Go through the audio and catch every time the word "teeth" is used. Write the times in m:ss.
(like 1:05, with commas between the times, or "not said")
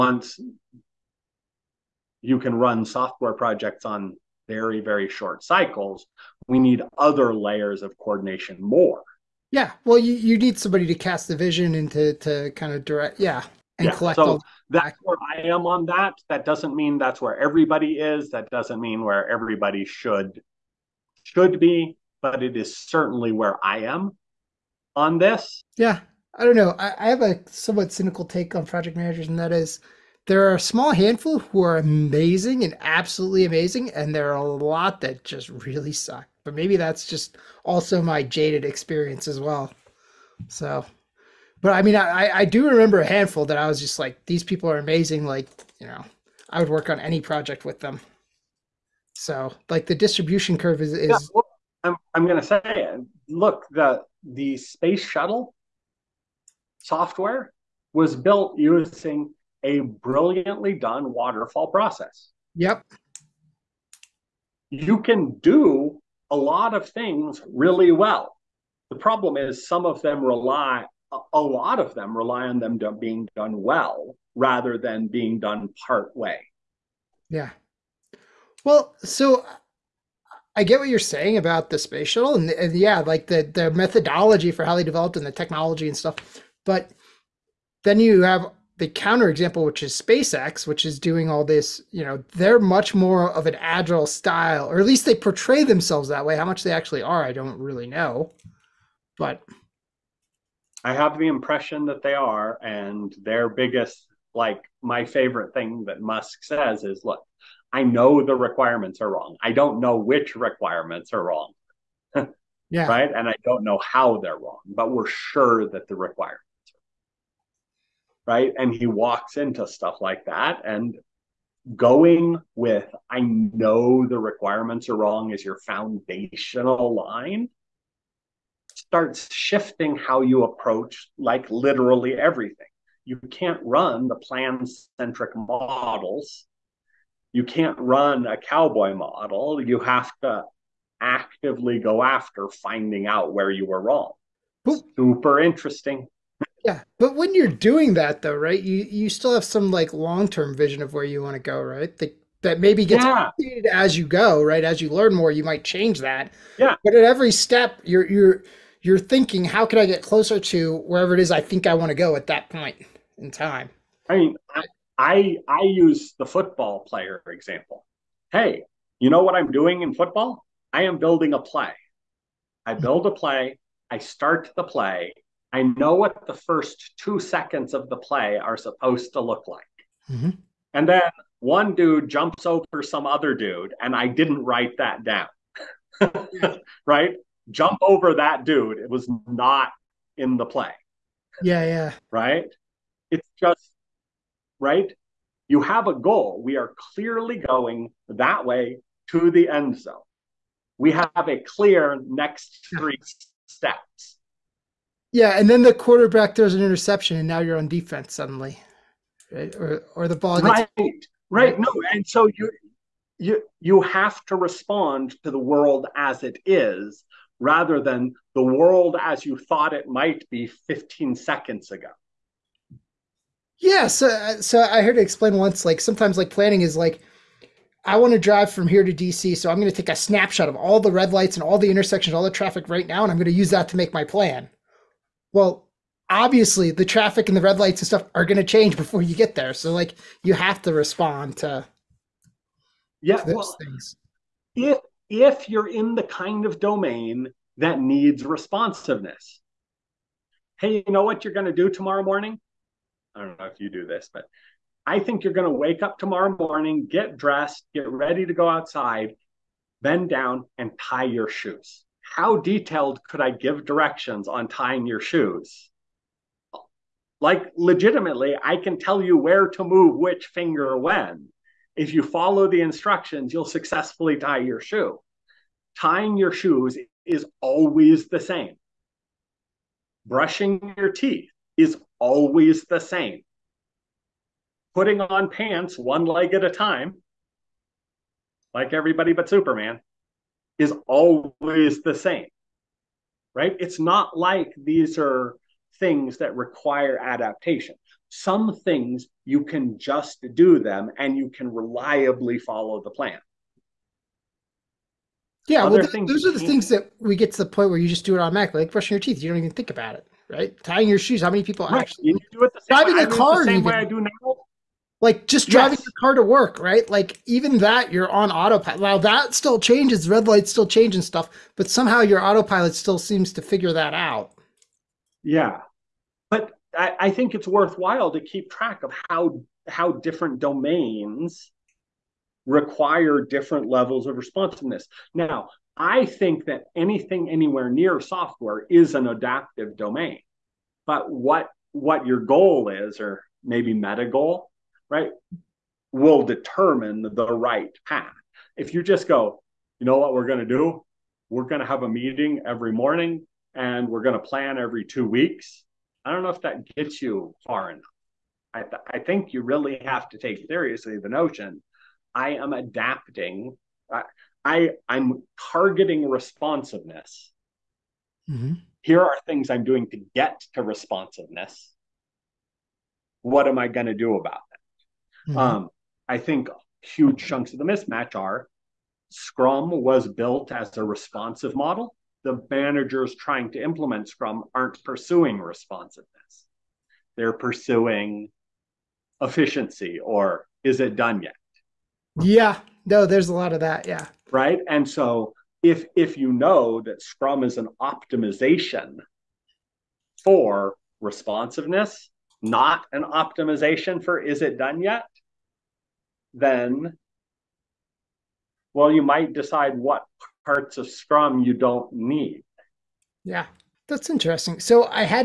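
4:40, 5:08.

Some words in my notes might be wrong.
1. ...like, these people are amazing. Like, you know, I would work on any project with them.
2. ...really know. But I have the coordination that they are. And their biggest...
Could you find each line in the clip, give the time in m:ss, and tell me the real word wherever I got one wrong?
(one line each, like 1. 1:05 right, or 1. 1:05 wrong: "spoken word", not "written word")
1. 0:43 right
2. 1:37 wrong: "impression", not "coordination".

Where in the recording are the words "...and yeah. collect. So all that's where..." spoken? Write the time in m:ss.
0:13.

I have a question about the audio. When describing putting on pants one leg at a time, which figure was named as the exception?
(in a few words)
Superman.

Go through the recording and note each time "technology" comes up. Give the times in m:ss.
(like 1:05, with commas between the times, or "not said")
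1:25.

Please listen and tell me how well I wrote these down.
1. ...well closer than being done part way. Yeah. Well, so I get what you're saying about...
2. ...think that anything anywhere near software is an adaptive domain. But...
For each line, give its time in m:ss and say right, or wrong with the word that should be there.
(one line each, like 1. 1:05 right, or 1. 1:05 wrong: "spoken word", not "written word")
1. 1:13 wrong: "rather", not "closer"
2. 5:36 right.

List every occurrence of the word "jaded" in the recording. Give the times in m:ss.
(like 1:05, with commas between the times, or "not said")
0:38.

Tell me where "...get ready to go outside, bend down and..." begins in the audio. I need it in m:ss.
4:17.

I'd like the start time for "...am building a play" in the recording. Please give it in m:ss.
2:50.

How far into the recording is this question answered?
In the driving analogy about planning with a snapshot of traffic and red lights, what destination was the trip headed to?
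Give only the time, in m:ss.
3:48.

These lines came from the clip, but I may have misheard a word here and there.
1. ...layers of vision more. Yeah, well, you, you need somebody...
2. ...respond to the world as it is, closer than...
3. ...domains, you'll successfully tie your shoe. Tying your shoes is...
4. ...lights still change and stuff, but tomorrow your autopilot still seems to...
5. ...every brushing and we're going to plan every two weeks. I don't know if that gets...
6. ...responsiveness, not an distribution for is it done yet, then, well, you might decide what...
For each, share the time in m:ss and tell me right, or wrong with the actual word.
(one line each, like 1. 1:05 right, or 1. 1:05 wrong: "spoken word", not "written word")
1. 0:07 wrong: "coordination", not "vision"
2. 3:34 wrong: "rather", not "closer"
3. 4:32 wrong: "instructions", not "domains"
4. 5:20 wrong: "somehow", not "tomorrow"
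5. 5:52 wrong: "morning", not "brushing"
6. 6:40 wrong: "optimization", not "distribution".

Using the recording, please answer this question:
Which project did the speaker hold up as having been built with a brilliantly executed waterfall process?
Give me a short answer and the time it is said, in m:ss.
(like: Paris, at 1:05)
space shuttle software, at 0:54.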